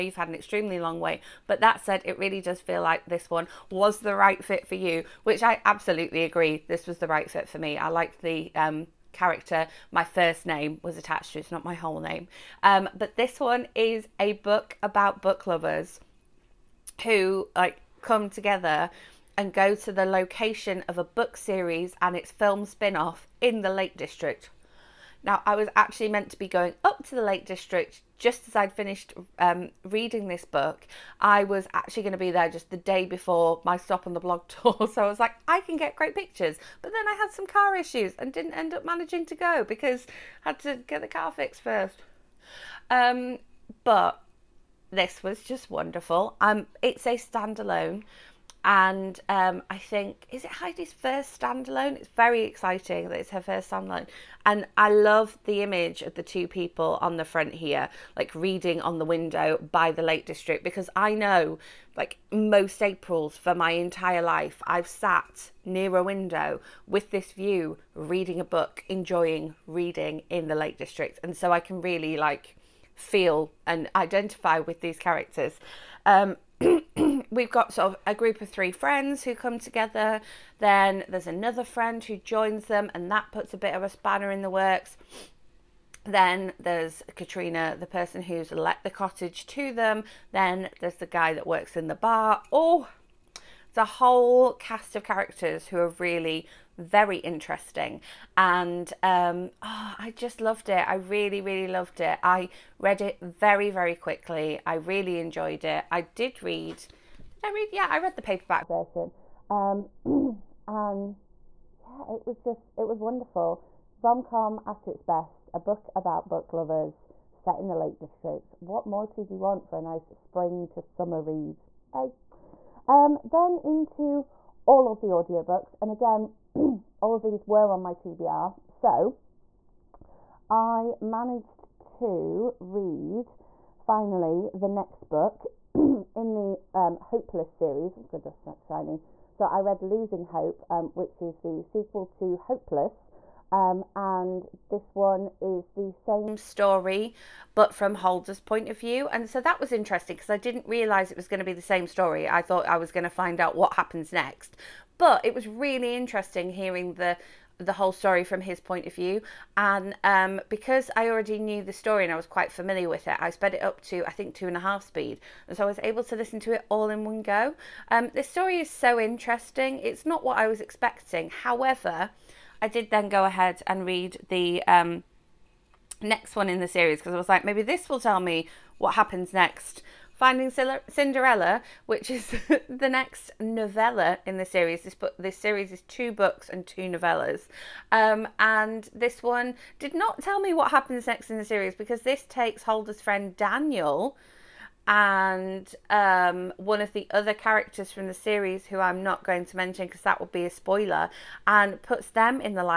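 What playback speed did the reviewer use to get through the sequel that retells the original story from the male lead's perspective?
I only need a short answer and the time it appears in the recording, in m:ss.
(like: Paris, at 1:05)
2.5, at 2:44.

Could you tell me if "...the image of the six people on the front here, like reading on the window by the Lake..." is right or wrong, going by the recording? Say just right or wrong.
wrong.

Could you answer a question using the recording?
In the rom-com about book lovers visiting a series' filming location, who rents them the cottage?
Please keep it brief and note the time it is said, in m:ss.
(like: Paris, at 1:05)
Katrina, at 1:27.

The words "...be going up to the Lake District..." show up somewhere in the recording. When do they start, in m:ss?
0:26.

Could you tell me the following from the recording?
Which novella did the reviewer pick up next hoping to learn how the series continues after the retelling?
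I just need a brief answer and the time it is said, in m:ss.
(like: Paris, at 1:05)
Finding Cinderella, at 3:00.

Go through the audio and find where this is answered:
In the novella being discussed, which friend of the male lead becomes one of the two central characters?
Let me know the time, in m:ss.
3:13.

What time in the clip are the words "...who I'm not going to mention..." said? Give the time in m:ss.
3:18.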